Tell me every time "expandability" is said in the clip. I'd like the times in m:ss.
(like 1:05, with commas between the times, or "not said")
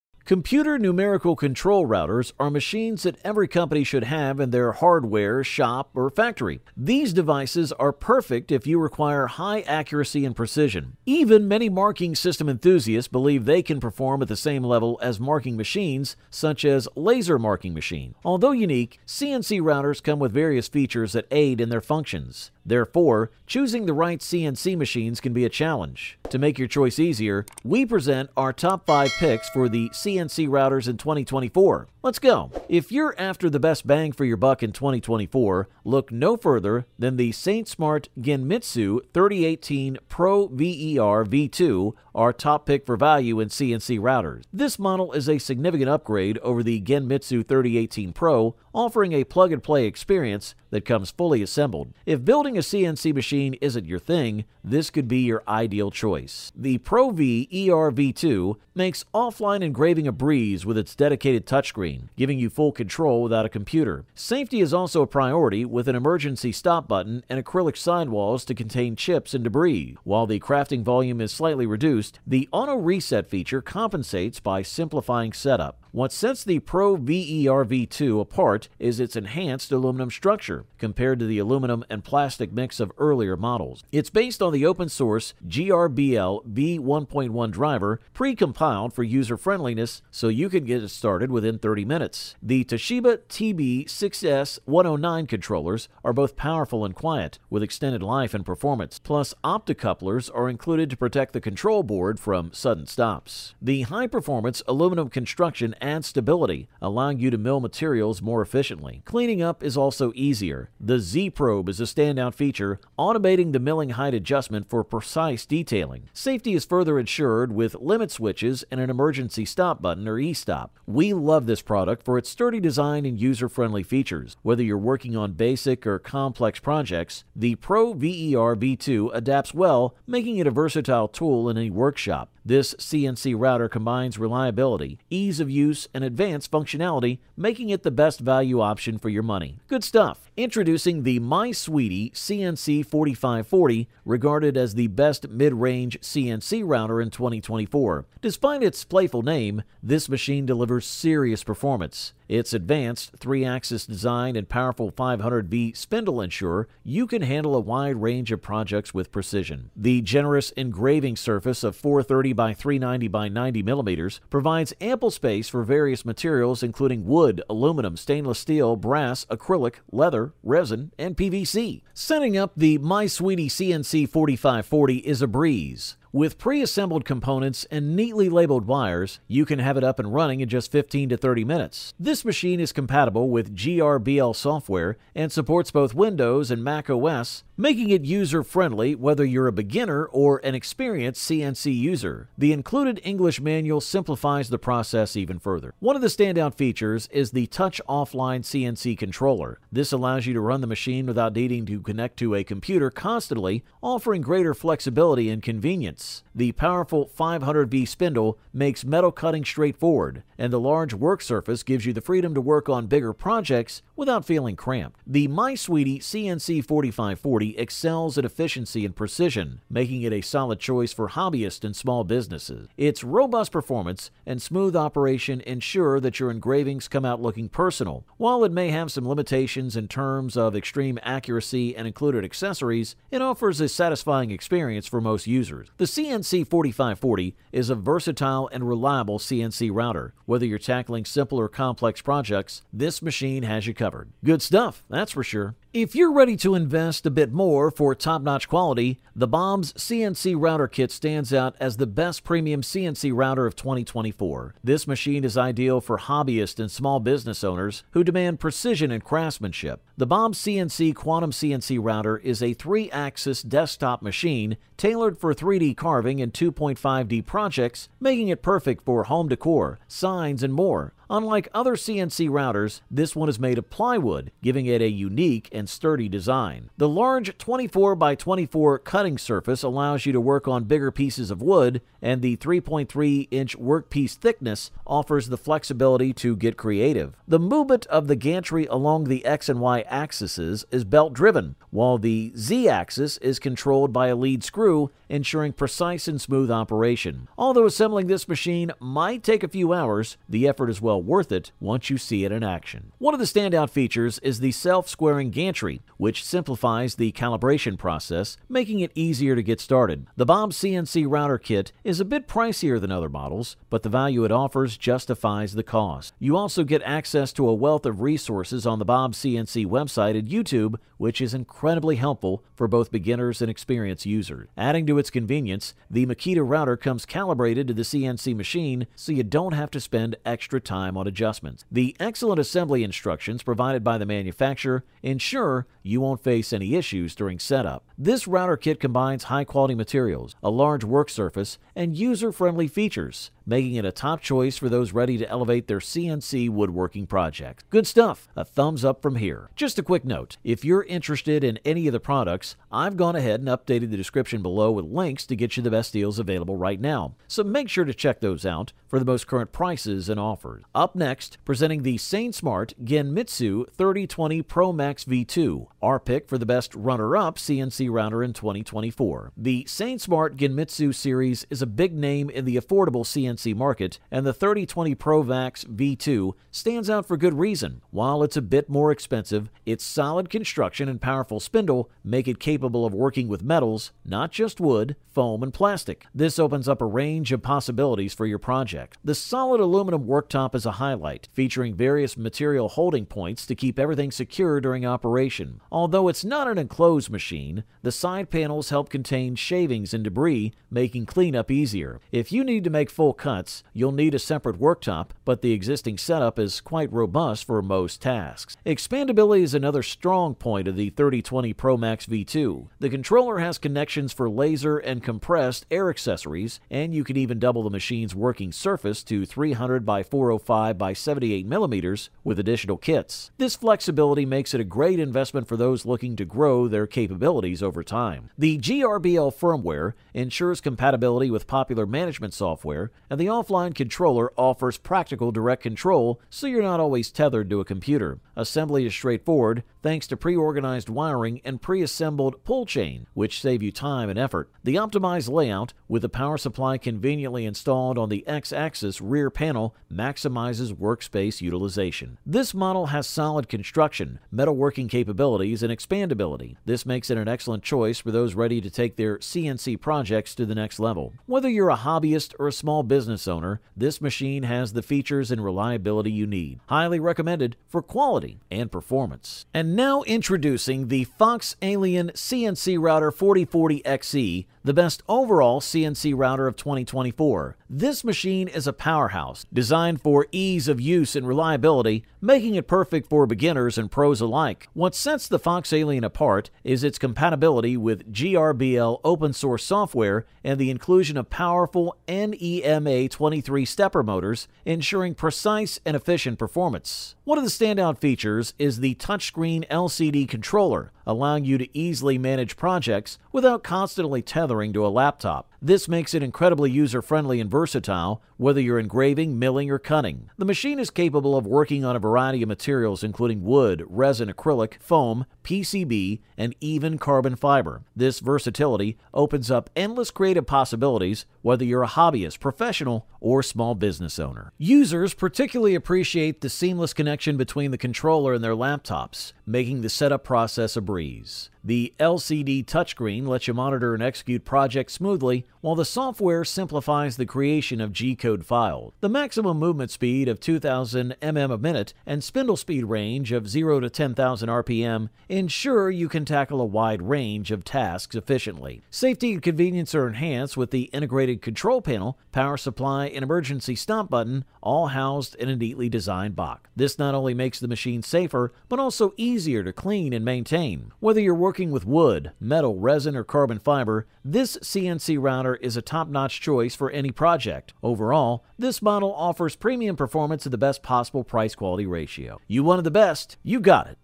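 6:48, 7:35.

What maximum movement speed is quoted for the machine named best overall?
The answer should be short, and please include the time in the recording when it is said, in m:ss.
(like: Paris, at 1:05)
2000 mm a minute, at 9:00.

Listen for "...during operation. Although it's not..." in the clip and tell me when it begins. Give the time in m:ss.
6:34.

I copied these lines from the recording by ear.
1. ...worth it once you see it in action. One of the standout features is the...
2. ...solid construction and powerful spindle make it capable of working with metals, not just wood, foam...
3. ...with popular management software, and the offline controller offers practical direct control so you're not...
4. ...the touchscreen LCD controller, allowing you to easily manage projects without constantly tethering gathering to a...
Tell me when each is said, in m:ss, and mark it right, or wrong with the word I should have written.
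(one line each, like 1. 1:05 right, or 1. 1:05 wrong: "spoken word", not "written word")
1. 5:01 right
2. 6:19 right
3. 7:11 right
4. 8:18 right.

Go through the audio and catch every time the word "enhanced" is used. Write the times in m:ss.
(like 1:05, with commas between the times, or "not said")
1:19, 9:10.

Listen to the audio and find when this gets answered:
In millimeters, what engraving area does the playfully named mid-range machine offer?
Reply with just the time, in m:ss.
2:41.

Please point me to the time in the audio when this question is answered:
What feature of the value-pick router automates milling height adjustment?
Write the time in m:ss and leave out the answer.
1:50.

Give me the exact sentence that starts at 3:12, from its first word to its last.
The included English manual simplifies the process even further.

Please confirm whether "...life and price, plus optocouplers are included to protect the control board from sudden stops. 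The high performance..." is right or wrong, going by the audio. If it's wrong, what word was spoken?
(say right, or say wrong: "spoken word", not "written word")
wrong: "performance", not "price".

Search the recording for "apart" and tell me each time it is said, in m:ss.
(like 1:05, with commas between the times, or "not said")
1:18, 8:06.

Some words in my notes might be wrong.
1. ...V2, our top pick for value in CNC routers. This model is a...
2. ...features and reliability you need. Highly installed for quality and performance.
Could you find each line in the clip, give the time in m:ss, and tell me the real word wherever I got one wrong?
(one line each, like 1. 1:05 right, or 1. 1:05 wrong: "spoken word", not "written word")
1. 0:41 right
2. 7:44 wrong: "recommended", not "installed".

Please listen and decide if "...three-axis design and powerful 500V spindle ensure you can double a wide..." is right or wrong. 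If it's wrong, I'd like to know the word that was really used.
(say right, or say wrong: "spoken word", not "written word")
wrong: "handle", not "double".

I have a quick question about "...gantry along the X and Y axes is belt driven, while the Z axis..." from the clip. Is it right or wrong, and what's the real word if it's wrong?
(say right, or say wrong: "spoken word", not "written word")
right.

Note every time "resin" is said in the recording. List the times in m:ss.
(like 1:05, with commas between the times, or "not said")
2:50, 8:33, 9:22.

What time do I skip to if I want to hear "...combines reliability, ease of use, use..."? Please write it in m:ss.
2:13.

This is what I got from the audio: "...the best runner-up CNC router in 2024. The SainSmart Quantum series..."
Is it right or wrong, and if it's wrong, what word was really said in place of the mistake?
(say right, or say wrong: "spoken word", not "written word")
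wrong: "Genmitsu", not "Quantum".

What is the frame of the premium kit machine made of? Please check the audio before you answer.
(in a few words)
Plywood.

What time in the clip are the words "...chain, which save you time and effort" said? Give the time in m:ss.
7:22.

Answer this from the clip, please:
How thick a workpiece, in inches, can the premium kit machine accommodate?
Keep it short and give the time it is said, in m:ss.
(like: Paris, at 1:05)
3.3 inch, at 4:42.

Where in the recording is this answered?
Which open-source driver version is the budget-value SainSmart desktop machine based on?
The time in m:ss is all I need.
1:25.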